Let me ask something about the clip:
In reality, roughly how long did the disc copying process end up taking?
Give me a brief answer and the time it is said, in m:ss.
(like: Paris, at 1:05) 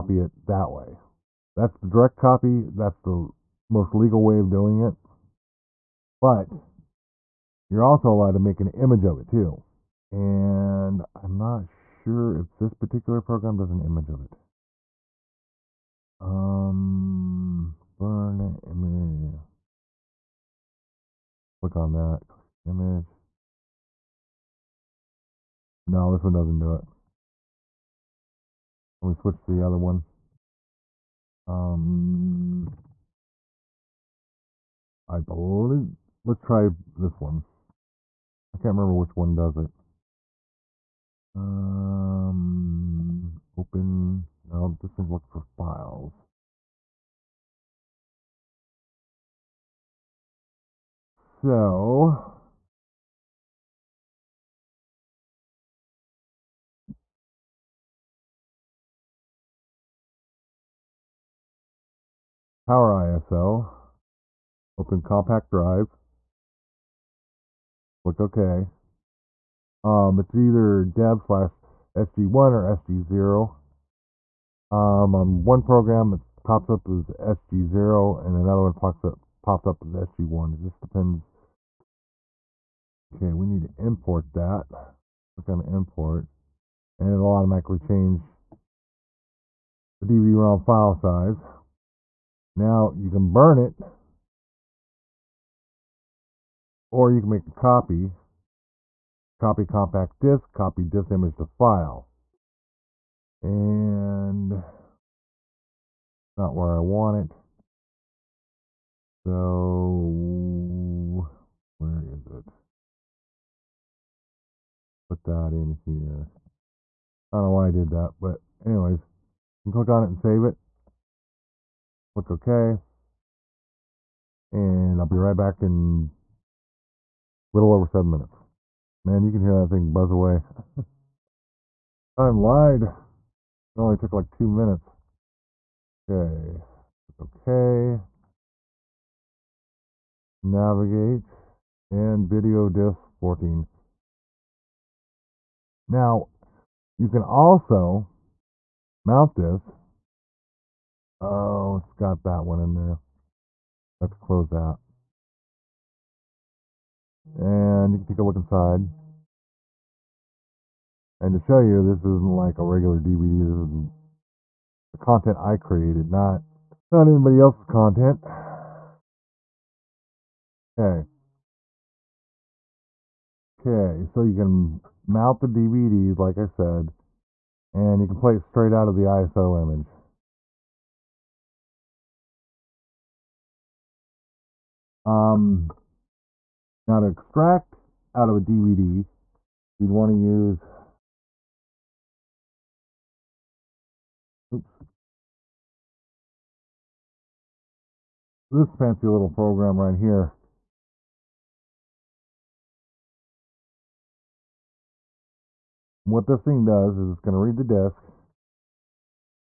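2 minutes, at 2:14.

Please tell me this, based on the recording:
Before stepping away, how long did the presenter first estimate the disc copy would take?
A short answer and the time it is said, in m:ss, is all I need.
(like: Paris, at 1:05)
a little over 7 minutes, at 2:07.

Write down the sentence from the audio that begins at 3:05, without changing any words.
Um, now to extract out of a DVD, you'd want to use, oops, this fancy little program right here.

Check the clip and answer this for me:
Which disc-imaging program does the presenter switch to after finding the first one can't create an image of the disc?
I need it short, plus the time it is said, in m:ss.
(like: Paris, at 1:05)
Power ISO, at 1:02.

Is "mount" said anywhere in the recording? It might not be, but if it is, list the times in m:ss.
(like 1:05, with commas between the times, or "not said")
2:29, 2:55.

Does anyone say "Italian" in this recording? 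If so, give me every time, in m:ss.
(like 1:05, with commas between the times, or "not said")
not said.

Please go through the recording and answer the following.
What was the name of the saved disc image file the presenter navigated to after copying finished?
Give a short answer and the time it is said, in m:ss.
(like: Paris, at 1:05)
video disc 14, at 2:22.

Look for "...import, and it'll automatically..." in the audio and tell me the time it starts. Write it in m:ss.
1:25.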